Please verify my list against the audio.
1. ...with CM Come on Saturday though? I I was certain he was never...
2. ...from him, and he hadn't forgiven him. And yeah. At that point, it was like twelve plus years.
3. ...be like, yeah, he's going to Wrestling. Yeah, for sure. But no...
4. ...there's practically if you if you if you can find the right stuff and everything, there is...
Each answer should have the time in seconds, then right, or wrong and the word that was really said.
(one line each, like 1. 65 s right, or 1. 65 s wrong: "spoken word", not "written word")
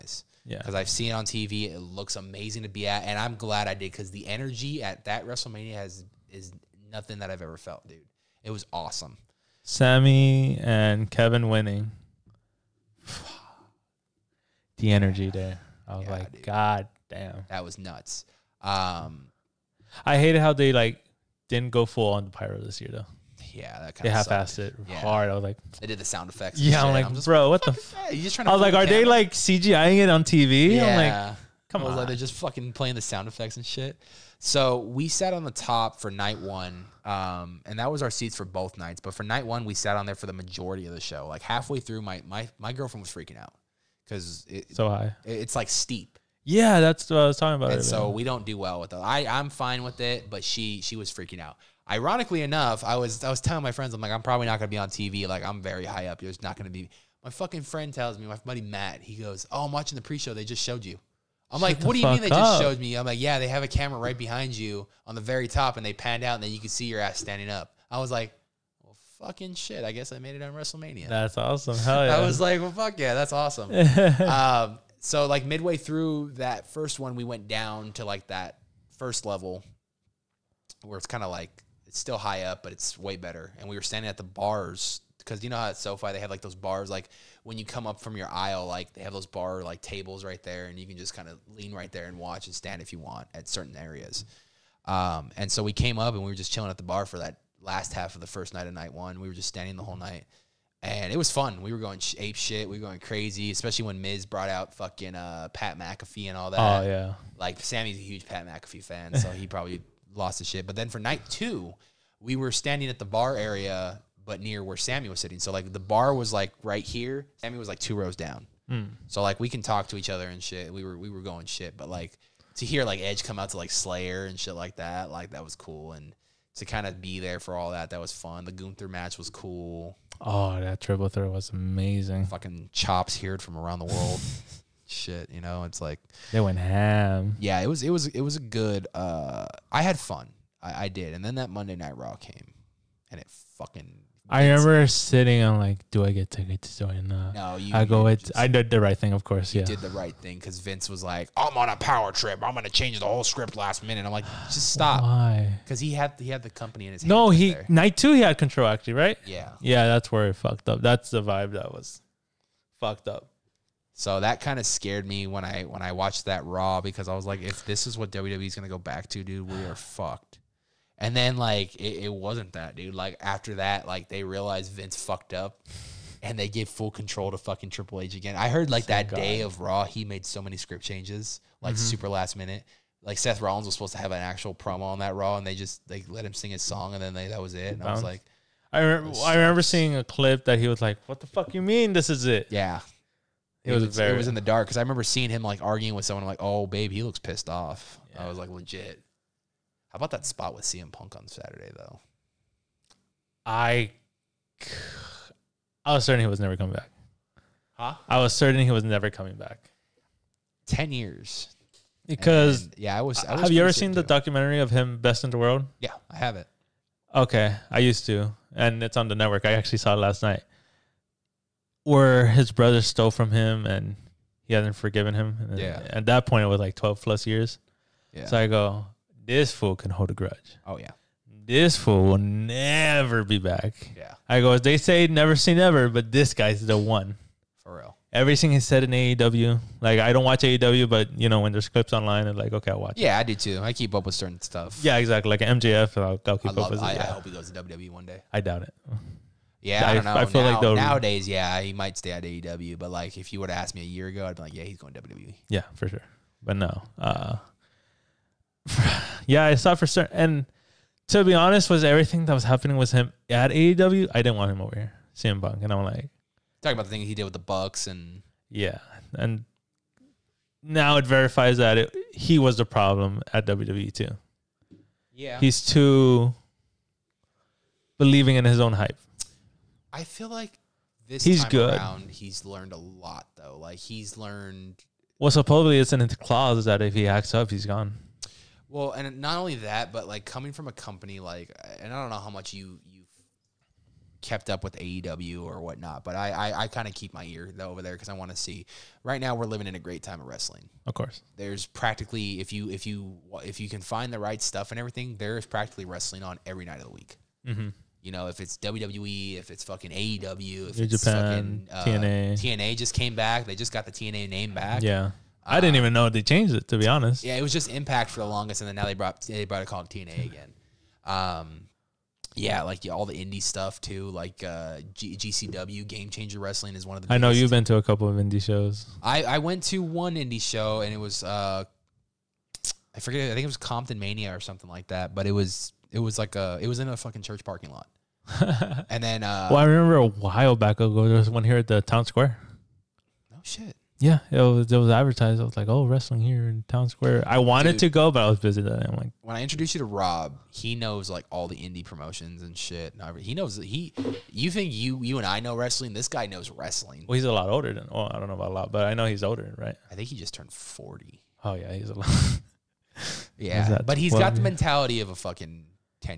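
1. 200 s wrong: "Punk", not "Come"
2. 223 s right
3. 254 s wrong: "WWE", not "Wrestling"
4. 301 s right.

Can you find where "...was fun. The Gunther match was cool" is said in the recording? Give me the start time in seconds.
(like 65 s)
127 s.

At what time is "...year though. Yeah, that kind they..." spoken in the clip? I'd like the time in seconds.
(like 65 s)
22 s.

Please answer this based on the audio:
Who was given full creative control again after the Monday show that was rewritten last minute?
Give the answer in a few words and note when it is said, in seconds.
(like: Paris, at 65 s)
Triple H, at 177 s.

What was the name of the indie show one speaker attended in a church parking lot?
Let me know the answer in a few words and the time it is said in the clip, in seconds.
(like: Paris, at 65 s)
Compton Mania, at 333 s.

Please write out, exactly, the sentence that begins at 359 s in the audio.
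I think he just turned forty.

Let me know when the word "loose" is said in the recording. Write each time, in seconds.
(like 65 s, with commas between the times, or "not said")
not said.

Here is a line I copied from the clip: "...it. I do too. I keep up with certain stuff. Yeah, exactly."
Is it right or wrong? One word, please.
right.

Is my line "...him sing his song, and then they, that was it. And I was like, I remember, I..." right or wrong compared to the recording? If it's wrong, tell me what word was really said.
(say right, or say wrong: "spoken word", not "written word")
right.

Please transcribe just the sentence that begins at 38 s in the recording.
But for night one, we sat on there for the majority of the show.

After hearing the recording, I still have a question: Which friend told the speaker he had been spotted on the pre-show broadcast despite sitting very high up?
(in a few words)
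Matt.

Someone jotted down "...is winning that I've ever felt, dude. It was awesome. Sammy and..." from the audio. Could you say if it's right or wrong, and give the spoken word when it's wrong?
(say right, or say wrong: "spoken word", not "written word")
wrong: "nothing", not "winning".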